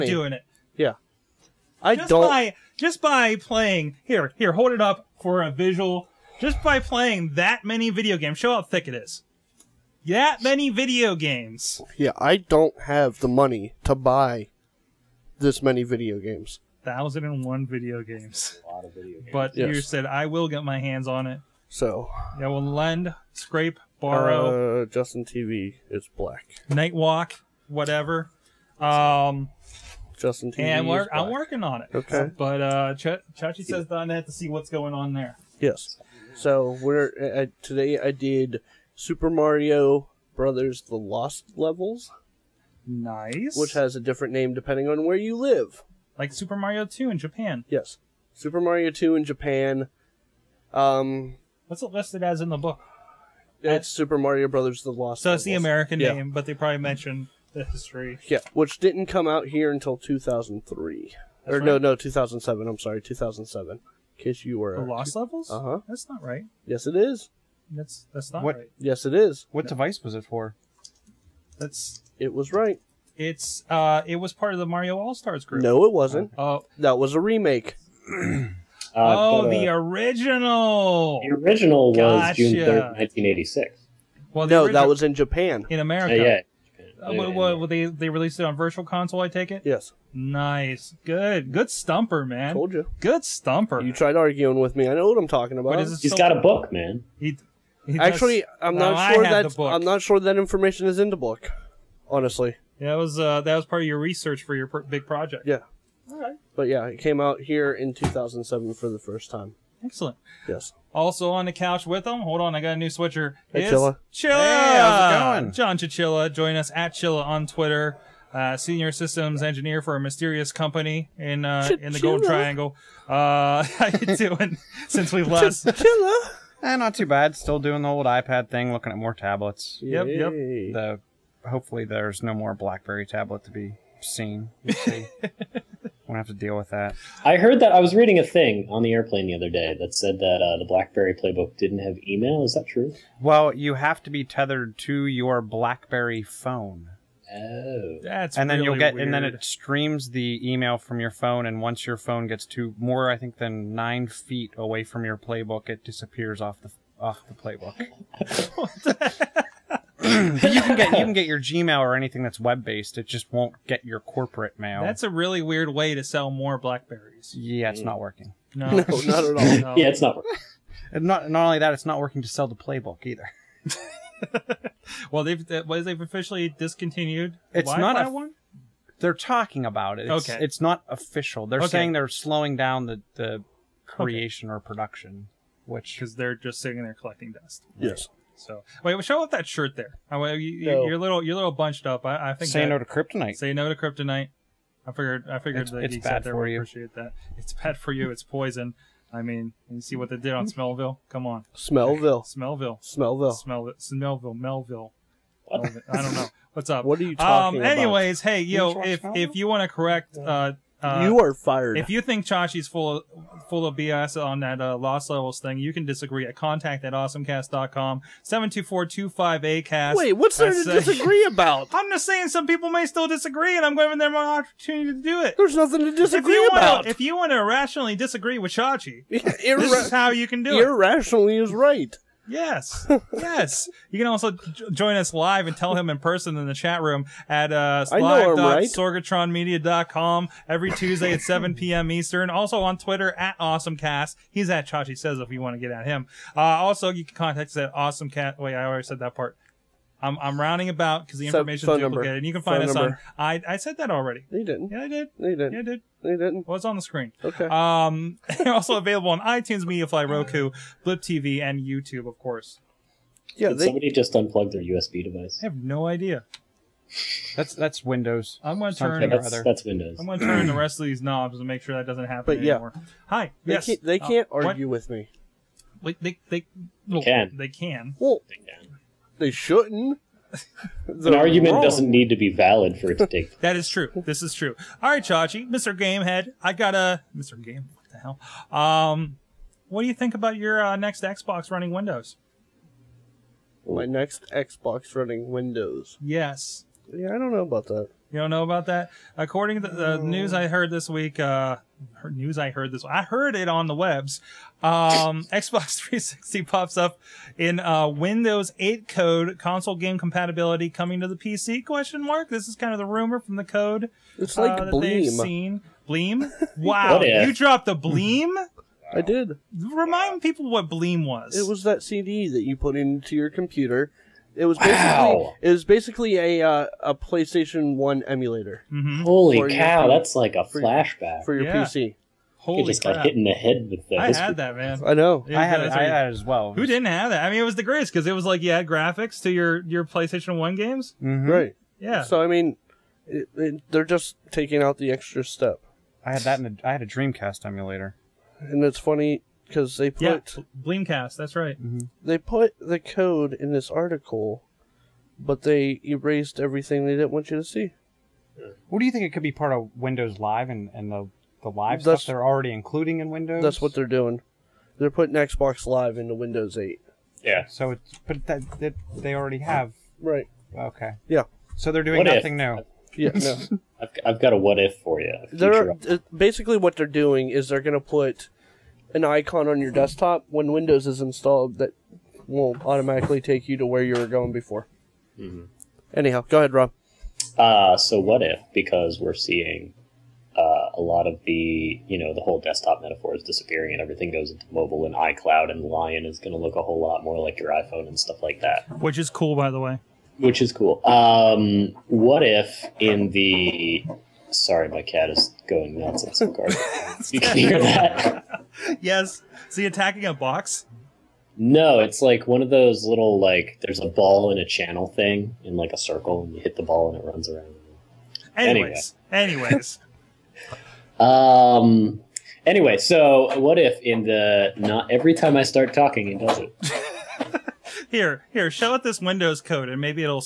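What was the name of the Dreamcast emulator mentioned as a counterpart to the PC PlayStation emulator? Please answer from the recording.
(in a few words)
Bleemcast.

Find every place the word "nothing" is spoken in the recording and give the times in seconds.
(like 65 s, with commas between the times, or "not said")
225 s, 372 s.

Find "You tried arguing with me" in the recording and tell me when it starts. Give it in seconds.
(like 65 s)
93 s.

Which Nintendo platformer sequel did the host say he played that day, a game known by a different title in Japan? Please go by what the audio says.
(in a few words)
Super Mario Brothers: The Lost Levels.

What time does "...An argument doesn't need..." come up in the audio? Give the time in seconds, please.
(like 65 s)
280 s.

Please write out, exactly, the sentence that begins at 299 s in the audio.
According to the news I heard this week, uh, news I heard this, I heard it on the webs.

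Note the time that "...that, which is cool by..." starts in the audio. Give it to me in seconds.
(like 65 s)
398 s.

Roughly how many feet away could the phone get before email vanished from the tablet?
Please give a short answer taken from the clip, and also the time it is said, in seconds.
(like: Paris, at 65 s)
9 feet, at 153 s.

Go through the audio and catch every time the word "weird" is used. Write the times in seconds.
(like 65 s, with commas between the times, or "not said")
148 s, 165 s.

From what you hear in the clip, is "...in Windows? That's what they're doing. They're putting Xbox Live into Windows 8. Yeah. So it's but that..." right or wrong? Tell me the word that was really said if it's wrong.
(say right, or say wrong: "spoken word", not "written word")
right.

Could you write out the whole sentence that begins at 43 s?
Which has a different name depending on where you live.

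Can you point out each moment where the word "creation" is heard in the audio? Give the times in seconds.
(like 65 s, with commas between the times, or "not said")
183 s.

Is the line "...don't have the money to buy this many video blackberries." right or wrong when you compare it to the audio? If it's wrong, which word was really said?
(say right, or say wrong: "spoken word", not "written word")
wrong: "games", not "blackberries".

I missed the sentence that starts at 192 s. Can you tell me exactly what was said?
I, I think say that, no to kryptonite.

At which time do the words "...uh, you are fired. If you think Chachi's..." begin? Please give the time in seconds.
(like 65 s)
210 s.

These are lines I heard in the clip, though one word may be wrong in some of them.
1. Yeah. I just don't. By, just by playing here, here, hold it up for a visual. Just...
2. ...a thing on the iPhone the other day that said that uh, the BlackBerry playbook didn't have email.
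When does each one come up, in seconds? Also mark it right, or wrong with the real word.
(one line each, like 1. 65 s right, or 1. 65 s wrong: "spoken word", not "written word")
1. 0 s right
2. 138 s wrong: "airplane", not "iPhone".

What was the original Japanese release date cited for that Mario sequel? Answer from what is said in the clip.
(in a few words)
June 3rd, 1986.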